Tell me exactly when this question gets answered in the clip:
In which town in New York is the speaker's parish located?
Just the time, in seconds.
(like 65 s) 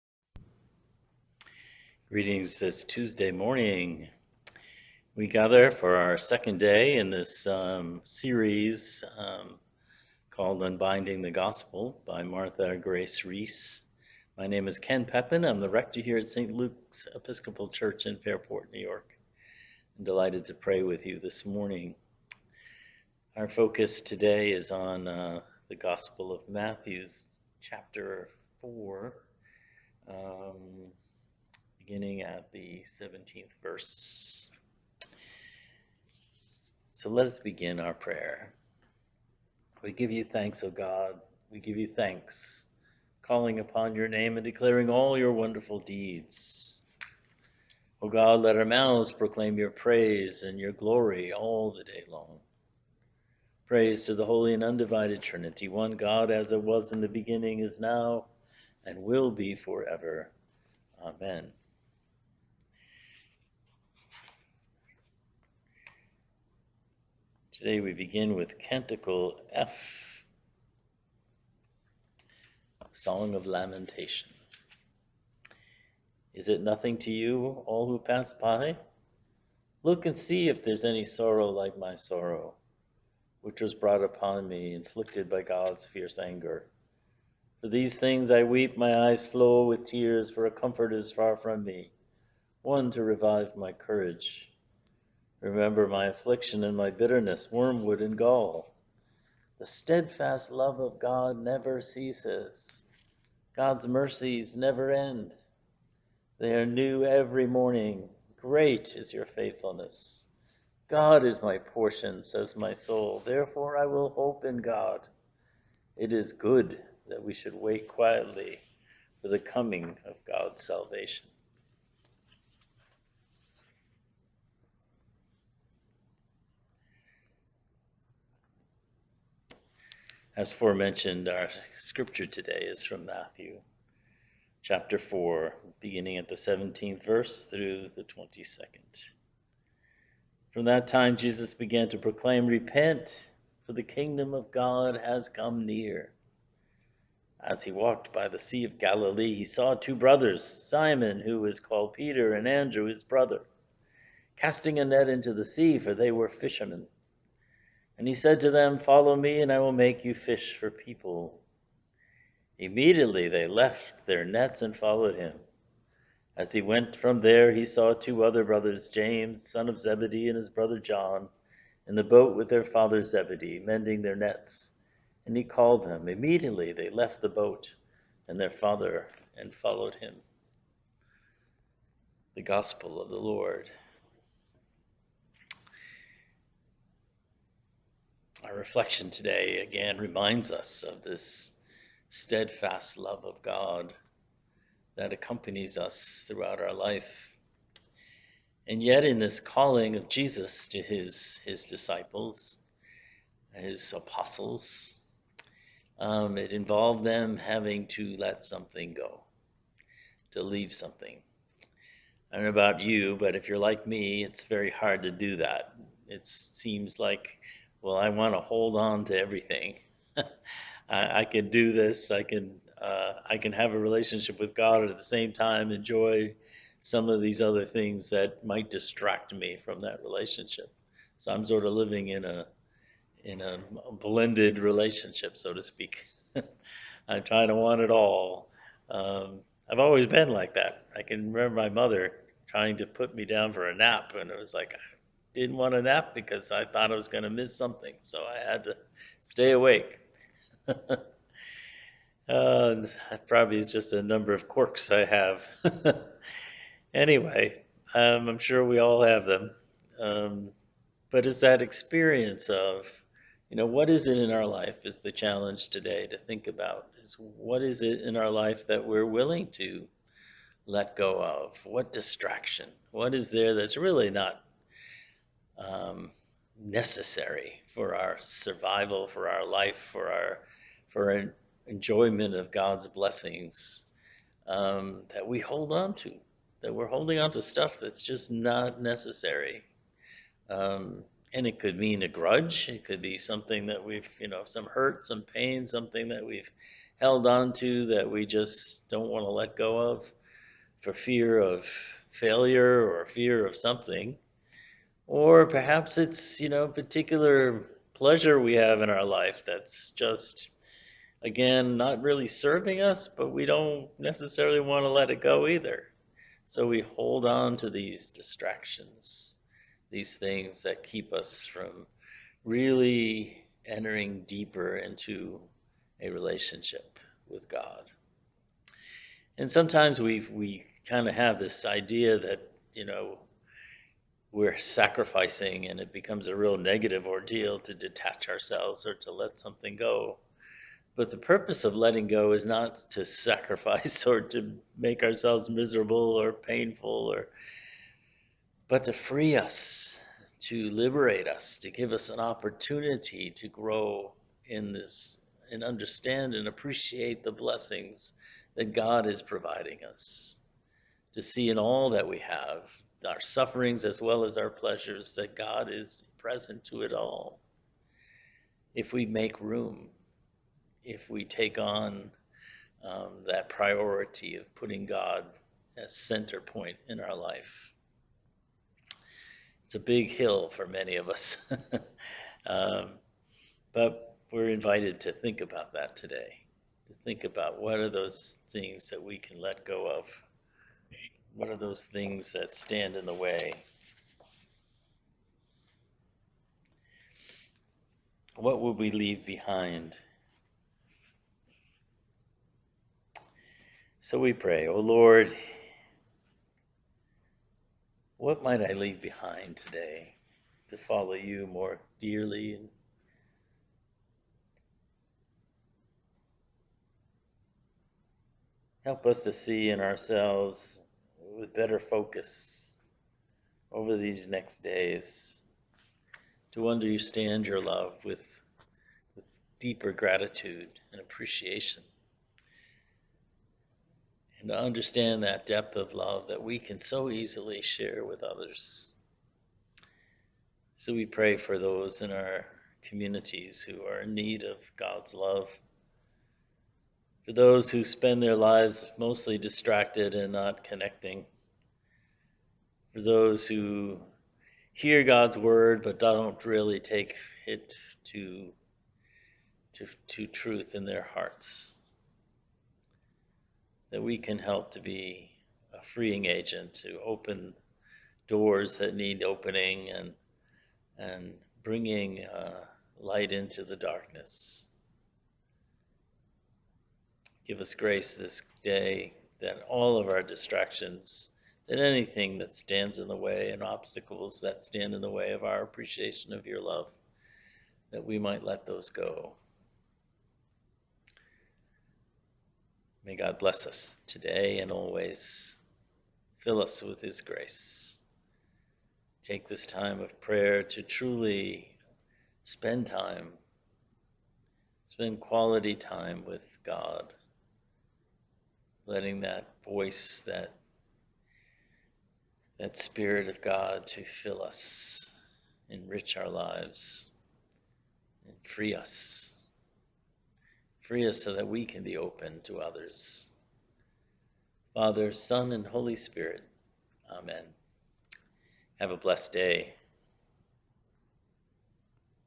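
18 s.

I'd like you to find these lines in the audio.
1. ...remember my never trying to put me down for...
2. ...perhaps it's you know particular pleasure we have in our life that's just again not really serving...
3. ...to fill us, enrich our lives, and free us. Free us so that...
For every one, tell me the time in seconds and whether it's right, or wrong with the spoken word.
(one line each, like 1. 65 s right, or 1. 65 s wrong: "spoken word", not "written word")
1. 241 s wrong: "mother", not "never"
2. 305 s right
3. 513 s right.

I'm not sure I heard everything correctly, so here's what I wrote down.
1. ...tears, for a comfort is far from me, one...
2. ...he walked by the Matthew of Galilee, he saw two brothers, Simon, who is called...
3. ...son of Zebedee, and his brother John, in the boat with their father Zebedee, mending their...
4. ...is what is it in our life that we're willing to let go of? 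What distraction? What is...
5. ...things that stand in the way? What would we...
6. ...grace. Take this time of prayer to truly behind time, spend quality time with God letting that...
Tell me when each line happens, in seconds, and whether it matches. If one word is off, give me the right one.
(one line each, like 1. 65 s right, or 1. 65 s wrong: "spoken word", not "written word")
1. 89 s right
2. 147 s wrong: "Sea", not "Matthew"
3. 169 s right
4. 267 s right
5. 391 s right
6. 497 s wrong: "spend", not "behind".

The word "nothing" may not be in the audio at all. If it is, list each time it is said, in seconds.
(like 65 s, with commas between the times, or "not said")
76 s.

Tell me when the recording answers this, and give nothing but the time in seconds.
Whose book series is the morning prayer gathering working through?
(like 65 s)
12 s.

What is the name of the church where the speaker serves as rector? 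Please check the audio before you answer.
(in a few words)
St. Luke's Episcopal Church.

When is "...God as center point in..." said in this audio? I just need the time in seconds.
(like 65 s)
374 s.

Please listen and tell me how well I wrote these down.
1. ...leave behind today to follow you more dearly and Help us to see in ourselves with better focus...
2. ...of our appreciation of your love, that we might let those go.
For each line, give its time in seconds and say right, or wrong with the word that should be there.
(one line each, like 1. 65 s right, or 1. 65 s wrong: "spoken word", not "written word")
1. 408 s right
2. 485 s right.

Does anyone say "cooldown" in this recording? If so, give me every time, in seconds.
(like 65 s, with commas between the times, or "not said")
not said.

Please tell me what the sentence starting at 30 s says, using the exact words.
Um, beginning at the 17th verse.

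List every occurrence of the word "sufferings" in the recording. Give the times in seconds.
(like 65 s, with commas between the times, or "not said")
363 s.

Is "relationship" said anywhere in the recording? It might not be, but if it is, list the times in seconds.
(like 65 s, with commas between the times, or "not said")
223 s, 230 s, 234 s, 326 s.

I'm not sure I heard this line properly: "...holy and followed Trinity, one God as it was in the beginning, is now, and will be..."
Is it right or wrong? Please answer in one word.
wrong.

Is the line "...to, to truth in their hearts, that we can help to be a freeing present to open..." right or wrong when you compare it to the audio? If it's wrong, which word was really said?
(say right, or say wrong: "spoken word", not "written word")
wrong: "agent", not "present".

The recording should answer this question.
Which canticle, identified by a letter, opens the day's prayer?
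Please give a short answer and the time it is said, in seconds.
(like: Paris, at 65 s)
Canticle F, at 68 s.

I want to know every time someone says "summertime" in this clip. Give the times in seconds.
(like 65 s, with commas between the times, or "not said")
not said.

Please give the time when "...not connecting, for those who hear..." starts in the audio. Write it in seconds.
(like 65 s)
450 s.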